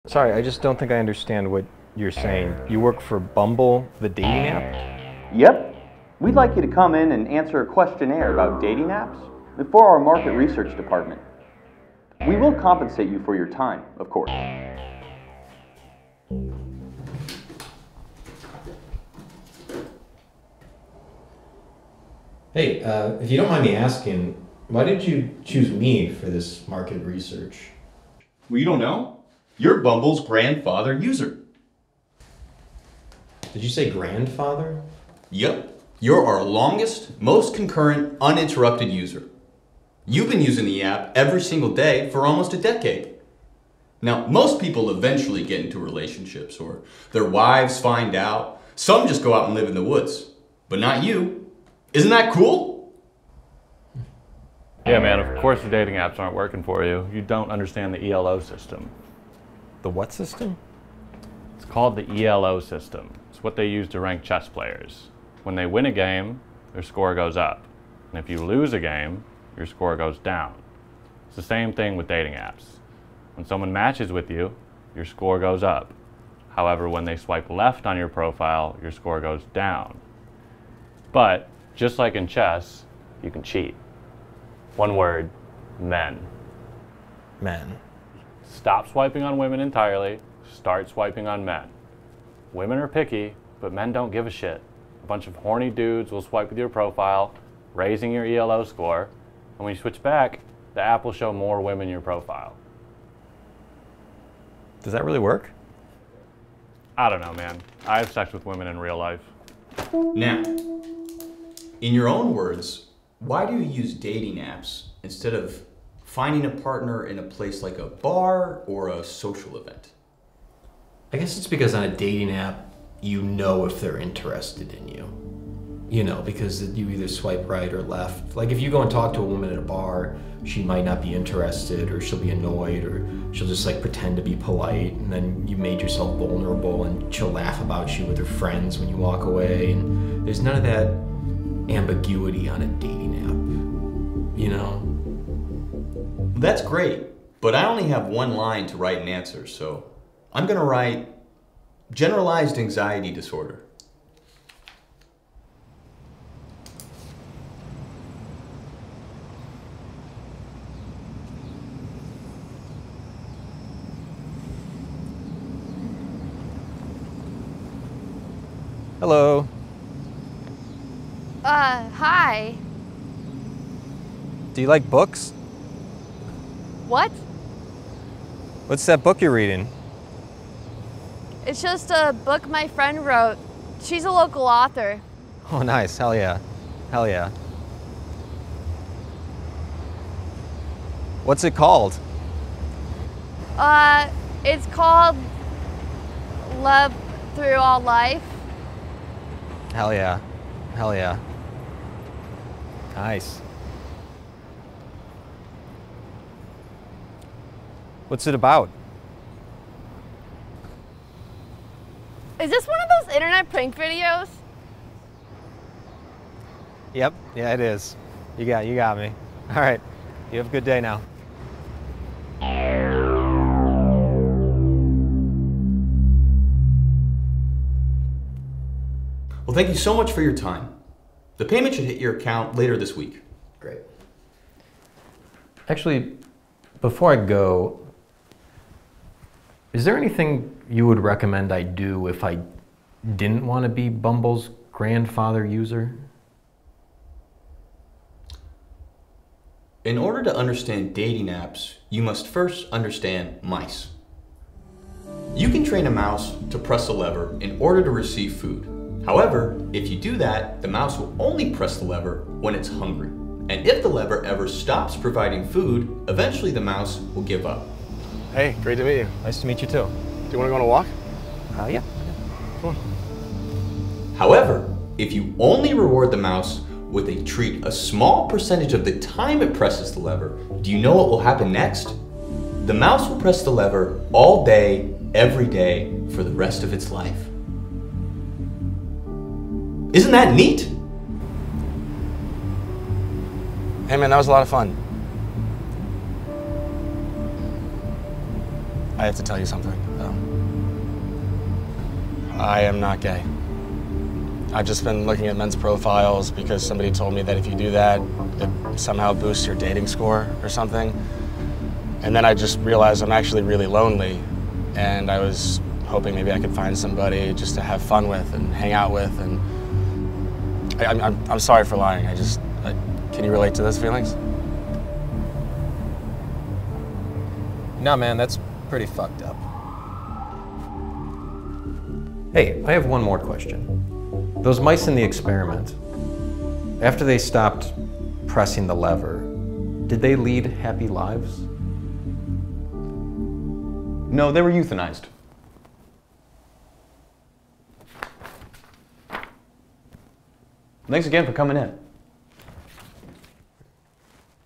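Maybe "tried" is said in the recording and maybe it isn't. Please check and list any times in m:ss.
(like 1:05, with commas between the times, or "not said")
not said.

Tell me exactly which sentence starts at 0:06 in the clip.
We'd like you to come in and answer a questionnaire about dating apps for our market research department.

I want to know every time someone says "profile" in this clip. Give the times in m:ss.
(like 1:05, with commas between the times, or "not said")
1:18, 1:36, 1:42, 5:05.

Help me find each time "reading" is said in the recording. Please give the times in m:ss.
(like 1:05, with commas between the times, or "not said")
2:59.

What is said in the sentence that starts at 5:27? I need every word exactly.
No, man, that's pretty fucked up.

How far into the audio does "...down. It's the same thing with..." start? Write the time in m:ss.
1:10.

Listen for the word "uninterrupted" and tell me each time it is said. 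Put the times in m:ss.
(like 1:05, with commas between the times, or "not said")
0:38.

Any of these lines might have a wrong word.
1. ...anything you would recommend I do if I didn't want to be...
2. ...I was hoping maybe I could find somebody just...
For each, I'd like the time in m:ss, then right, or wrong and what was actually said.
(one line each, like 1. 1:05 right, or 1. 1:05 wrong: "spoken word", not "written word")
1. 3:59 right
2. 5:15 right.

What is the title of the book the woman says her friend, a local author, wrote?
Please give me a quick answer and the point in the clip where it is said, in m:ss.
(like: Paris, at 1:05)
Love Through All Life, at 3:16.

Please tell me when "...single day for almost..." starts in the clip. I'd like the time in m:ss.
0:41.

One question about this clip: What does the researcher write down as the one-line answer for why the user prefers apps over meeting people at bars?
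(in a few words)
Generalized anxiety disorder.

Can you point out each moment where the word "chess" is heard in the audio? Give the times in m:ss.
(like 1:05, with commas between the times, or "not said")
1:04, 1:22.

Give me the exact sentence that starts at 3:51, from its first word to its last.
The payment should hit your account later this week.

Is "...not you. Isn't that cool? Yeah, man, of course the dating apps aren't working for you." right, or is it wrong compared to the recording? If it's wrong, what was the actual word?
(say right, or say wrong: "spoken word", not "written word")
right.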